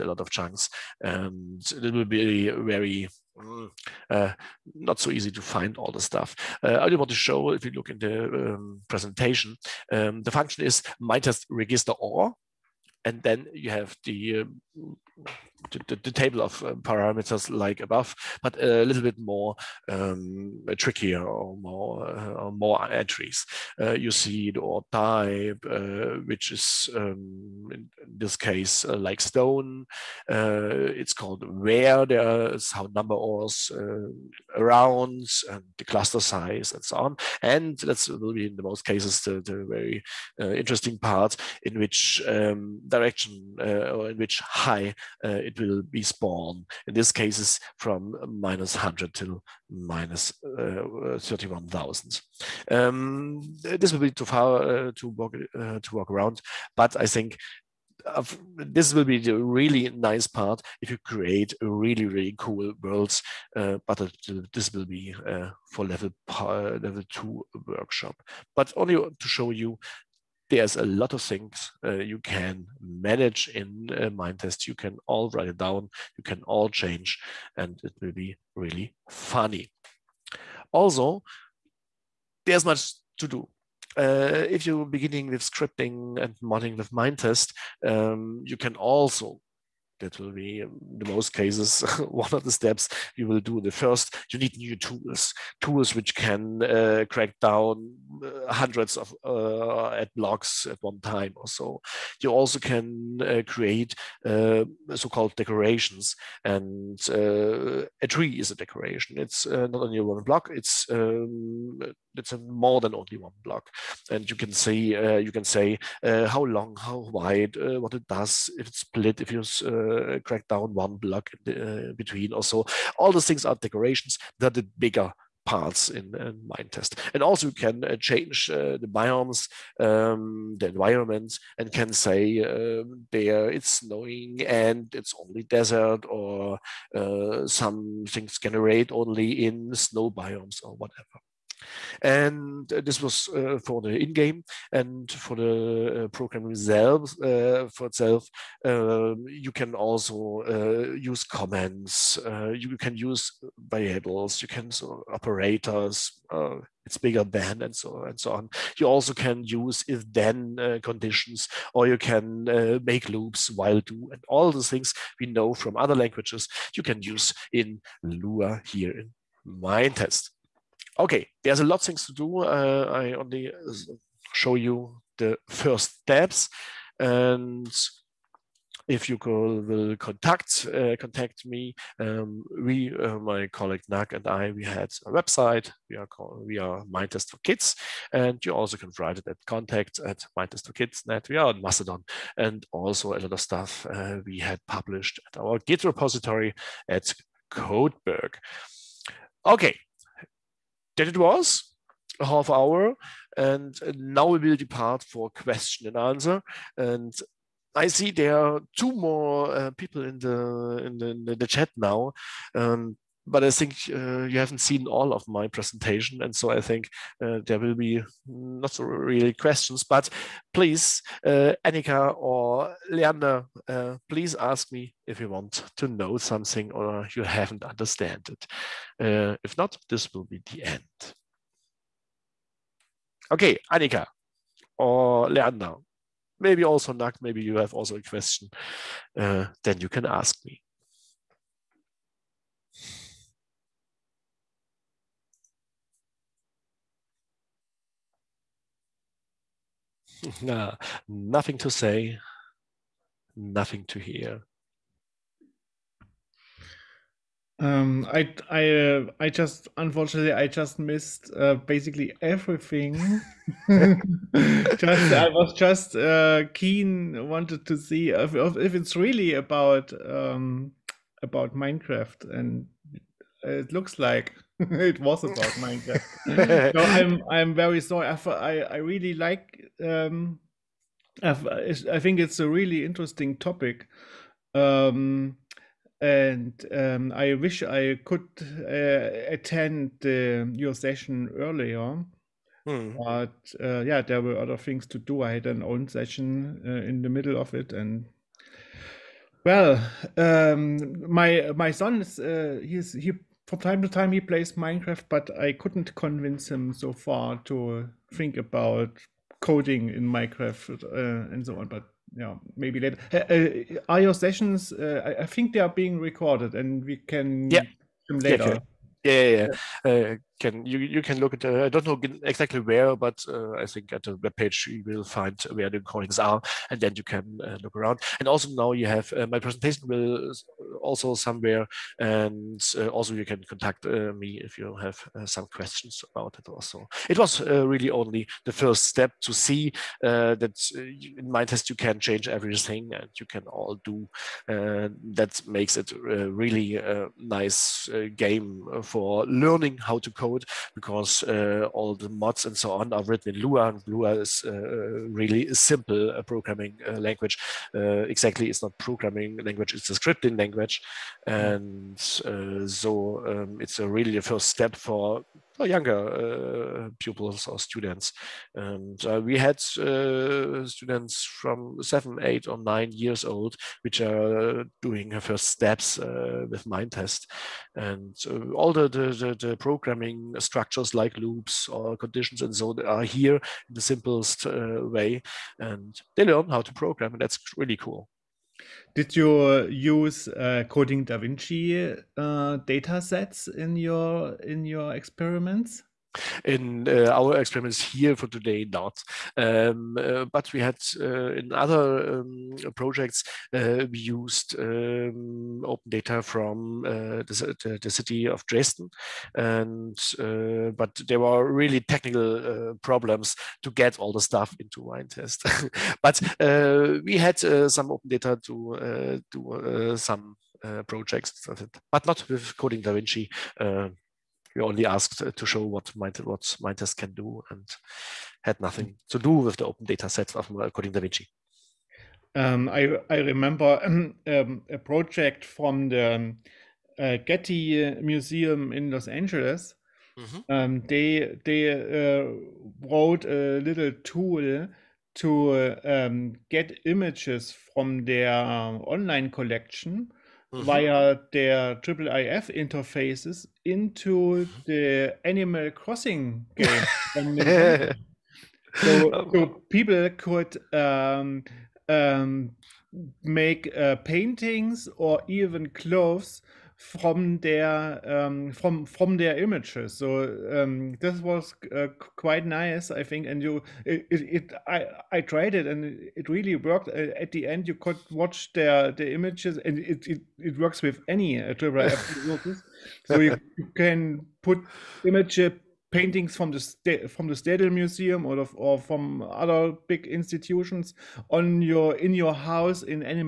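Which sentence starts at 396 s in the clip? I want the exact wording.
In uh, our experiments here for today, not.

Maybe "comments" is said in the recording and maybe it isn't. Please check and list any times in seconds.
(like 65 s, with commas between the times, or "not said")
151 s.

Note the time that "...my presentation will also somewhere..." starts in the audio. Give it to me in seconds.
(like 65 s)
329 s.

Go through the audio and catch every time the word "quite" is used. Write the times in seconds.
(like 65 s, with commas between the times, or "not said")
472 s.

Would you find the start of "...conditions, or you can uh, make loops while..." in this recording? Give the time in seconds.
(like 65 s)
160 s.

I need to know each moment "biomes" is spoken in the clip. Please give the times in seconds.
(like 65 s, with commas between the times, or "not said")
128 s, 140 s.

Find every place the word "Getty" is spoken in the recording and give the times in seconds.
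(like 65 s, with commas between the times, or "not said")
437 s.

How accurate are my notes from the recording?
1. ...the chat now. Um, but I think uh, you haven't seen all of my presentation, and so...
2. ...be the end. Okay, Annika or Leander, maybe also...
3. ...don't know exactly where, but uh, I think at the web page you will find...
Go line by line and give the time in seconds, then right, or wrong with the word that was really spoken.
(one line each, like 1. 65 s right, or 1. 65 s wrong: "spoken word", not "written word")
1. 211 s right
2. 230 s right
3. 321 s right.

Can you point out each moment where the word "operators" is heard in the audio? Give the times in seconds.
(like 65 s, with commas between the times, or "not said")
155 s.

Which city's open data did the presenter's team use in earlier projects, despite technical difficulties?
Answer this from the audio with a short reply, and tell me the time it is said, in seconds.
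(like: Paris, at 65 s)
Dresden, at 408 s.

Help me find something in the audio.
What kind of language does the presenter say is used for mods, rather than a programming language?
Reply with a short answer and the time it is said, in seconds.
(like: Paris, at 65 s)
scripting language, at 359 s.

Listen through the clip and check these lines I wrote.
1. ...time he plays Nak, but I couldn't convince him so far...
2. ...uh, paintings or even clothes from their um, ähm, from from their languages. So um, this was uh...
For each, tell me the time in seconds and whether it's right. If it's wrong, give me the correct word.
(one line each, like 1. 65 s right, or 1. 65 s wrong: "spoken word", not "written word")
1. 303 s wrong: "Minecraft", not "Nak"
2. 463 s wrong: "images", not "languages".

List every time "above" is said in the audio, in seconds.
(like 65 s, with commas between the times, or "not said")
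17 s.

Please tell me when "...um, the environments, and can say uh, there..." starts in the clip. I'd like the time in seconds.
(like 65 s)
129 s.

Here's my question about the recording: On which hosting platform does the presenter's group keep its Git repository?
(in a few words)
Codeberg.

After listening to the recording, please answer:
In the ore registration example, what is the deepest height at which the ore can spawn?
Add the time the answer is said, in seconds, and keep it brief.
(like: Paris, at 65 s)
-31000, at 49 s.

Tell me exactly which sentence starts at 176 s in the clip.
And if you call, will contact uh, contact me, um, we, uh, my colleague Nak and I, we had a website.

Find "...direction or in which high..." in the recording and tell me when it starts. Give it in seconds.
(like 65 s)
42 s.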